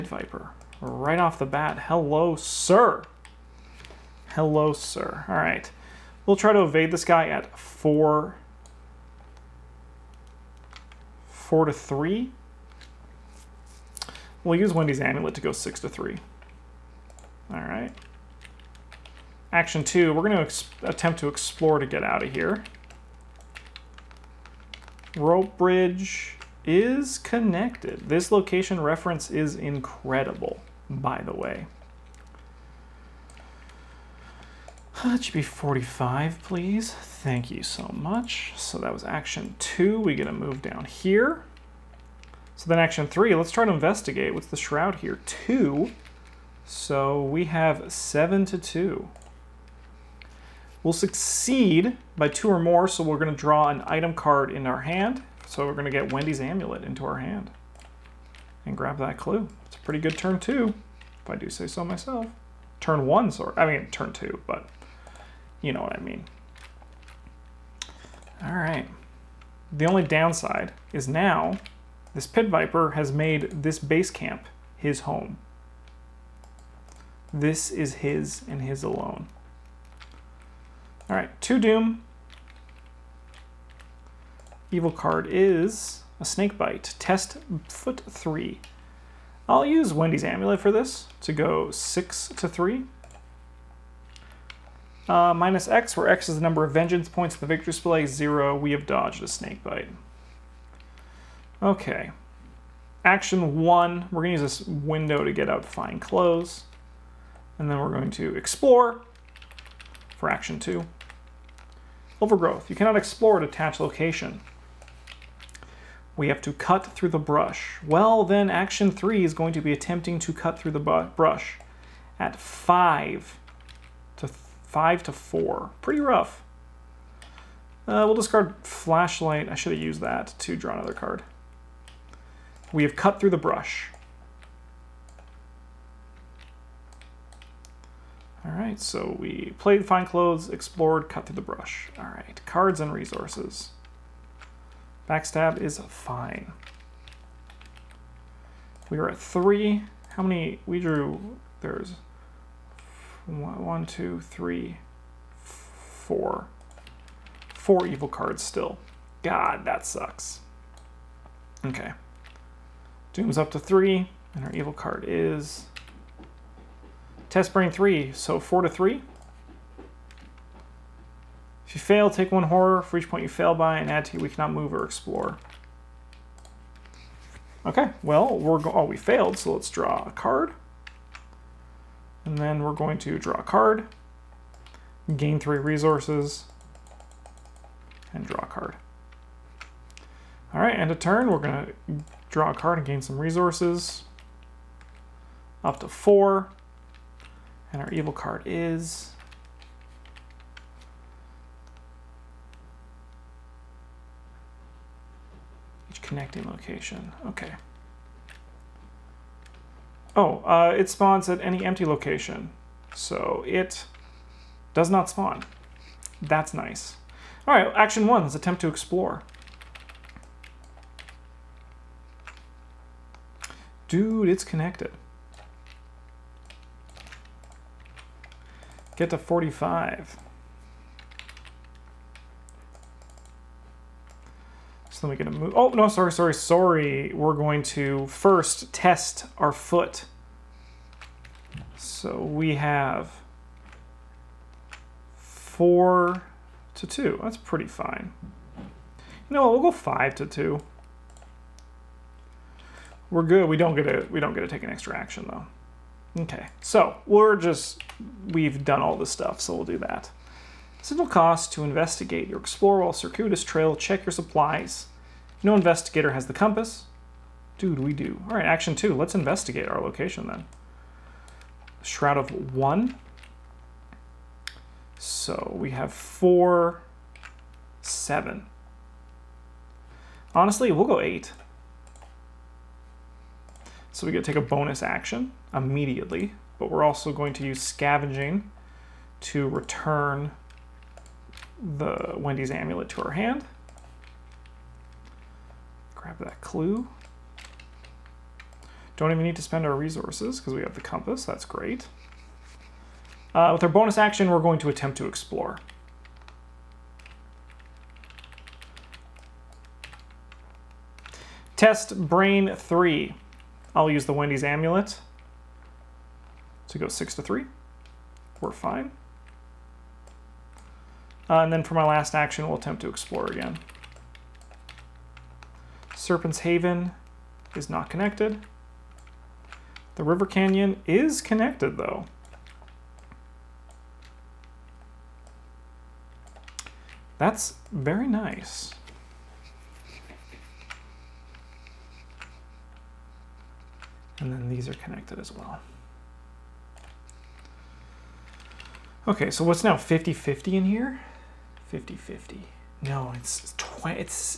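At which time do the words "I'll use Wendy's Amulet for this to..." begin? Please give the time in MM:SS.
01:29.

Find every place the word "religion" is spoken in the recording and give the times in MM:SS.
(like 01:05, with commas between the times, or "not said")
not said.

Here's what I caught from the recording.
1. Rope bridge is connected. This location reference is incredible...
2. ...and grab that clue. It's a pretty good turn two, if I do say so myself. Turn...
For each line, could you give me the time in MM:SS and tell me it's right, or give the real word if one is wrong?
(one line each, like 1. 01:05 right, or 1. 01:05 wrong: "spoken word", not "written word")
1. 00:25 right
2. 00:58 right.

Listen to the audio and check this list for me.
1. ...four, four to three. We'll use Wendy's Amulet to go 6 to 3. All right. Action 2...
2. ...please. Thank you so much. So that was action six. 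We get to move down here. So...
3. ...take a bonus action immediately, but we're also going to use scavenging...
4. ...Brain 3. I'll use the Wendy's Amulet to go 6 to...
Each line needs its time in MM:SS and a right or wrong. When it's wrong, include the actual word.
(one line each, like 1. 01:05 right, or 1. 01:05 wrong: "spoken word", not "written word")
1. 00:07 right
2. 00:36 wrong: "two", not "six"
3. 04:44 right
4. 05:12 right.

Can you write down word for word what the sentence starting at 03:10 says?
All right, end of turn, we're gonna Draw a card and gain some resources.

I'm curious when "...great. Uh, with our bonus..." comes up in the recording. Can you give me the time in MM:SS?
05:01.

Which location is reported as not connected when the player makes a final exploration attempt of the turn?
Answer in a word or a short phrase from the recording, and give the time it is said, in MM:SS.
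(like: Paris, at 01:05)
Serpent's Haven, at 05:25.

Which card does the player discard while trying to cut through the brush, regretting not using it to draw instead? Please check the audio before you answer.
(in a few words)
Flashlight.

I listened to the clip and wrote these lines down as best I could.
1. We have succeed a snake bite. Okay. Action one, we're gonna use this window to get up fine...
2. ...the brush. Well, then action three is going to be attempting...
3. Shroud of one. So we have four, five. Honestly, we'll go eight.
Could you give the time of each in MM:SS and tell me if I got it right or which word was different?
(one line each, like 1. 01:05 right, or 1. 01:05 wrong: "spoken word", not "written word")
1. 01:38 wrong: "dodged", not "succeed"
2. 01:57 right
3. 04:31 wrong: "seven", not "five".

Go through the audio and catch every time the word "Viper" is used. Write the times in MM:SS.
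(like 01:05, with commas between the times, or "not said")
00:00, 01:12.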